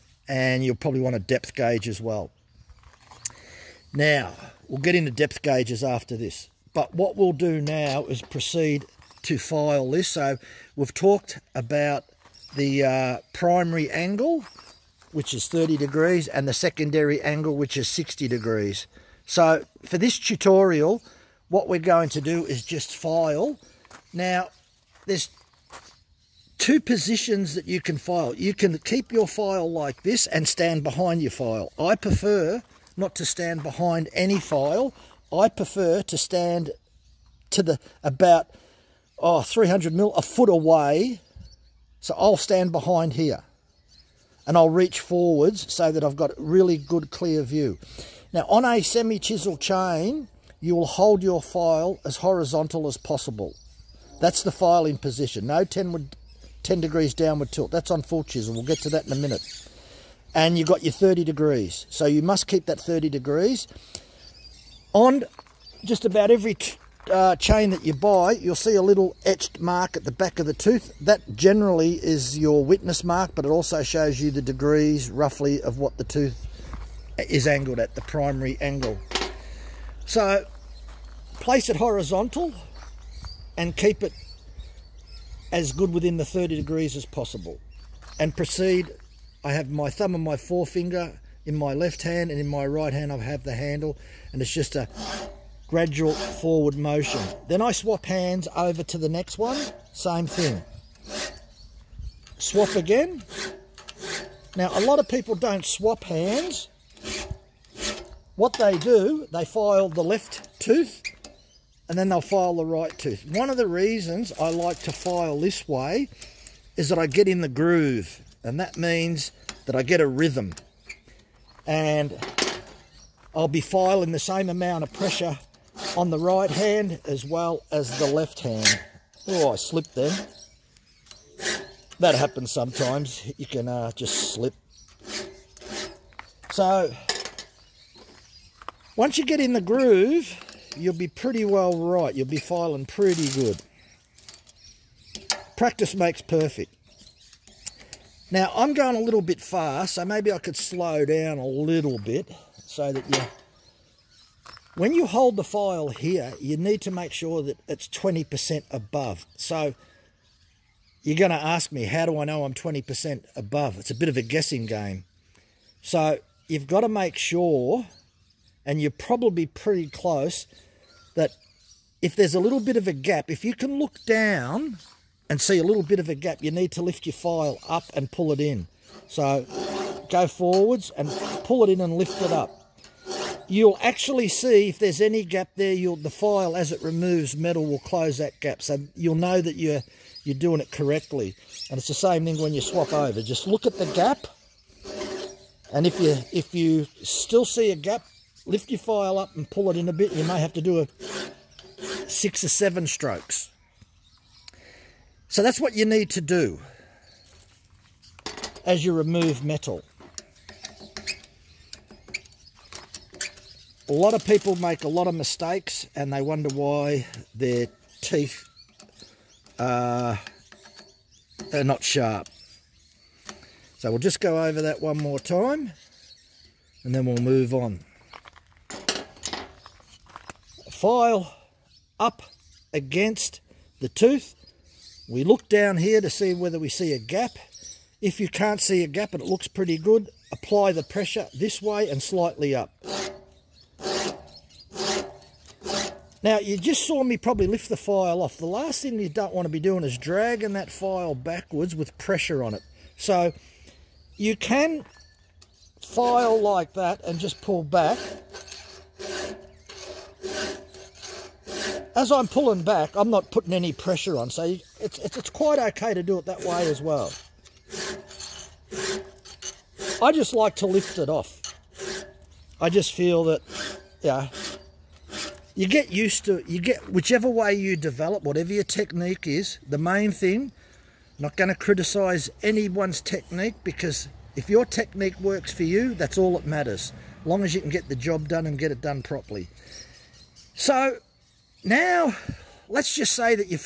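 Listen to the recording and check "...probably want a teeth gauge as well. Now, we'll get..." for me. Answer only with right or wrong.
wrong.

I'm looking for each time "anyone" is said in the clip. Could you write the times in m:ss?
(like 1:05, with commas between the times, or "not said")
4:42.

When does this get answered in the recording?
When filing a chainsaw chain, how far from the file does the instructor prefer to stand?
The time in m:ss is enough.
0:39.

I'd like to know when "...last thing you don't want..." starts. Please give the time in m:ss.
4:08.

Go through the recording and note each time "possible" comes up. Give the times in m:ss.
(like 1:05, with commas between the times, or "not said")
0:52, 1:27.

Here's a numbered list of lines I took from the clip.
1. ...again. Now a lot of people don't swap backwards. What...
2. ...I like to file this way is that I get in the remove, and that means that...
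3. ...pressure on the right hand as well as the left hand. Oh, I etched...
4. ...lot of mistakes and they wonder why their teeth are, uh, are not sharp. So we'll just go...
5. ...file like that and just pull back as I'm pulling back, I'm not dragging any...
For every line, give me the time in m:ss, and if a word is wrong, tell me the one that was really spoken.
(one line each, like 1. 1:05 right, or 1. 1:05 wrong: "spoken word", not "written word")
1. 1:42 wrong: "hands", not "backwards"
2. 1:54 wrong: "groove", not "remove"
3. 2:04 wrong: "slipped", not "etched"
4. 3:34 right
5. 4:15 wrong: "putting", not "dragging".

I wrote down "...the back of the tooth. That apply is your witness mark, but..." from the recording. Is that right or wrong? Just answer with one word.
wrong.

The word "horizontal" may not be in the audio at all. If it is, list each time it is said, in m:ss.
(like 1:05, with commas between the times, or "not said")
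0:52, 1:21.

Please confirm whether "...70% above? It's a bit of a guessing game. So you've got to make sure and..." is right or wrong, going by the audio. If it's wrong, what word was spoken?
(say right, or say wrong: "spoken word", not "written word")
wrong: "20", not "70".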